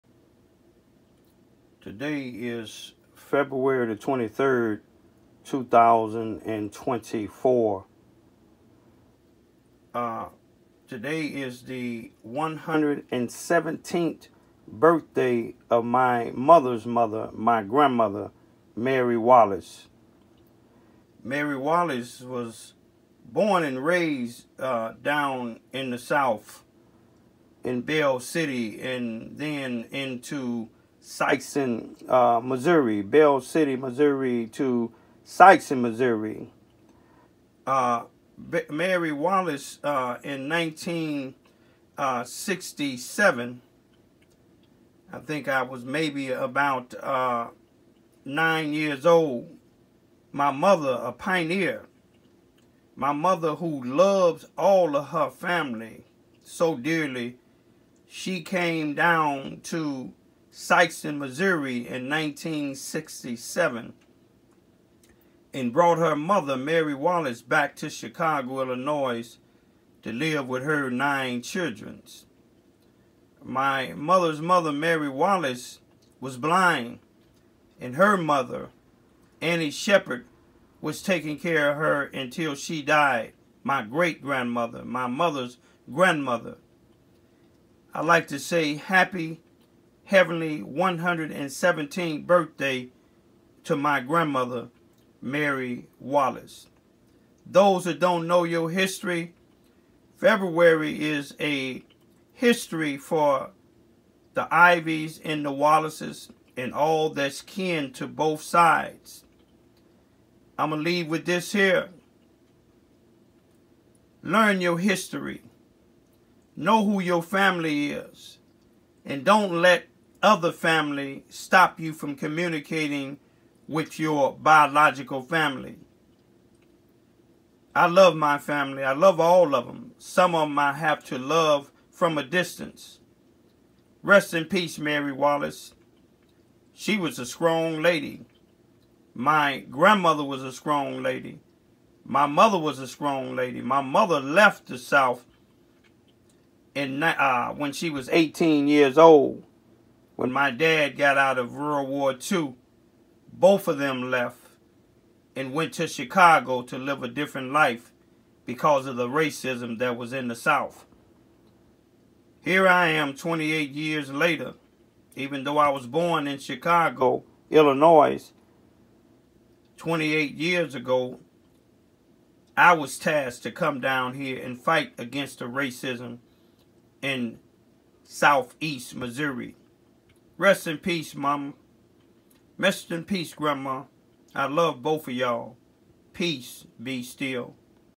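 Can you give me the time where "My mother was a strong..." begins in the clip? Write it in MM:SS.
02:22.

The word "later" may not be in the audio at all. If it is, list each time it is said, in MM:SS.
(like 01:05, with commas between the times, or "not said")
02:44.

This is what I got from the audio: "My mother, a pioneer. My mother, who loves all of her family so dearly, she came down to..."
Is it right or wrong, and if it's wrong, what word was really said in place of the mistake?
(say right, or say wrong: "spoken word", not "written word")
right.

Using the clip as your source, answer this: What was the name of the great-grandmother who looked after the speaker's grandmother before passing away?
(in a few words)
Annie Shepard.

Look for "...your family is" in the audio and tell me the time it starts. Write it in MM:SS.
01:56.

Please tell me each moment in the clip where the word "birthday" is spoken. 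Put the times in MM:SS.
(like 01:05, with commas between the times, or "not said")
00:14, 01:32.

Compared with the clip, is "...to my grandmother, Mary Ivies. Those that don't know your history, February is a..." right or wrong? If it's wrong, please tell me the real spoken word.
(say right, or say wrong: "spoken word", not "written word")
wrong: "Wallace", not "Ivies".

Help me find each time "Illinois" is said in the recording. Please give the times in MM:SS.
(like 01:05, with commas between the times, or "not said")
01:08, 02:47.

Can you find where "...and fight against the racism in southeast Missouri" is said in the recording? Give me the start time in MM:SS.
02:54.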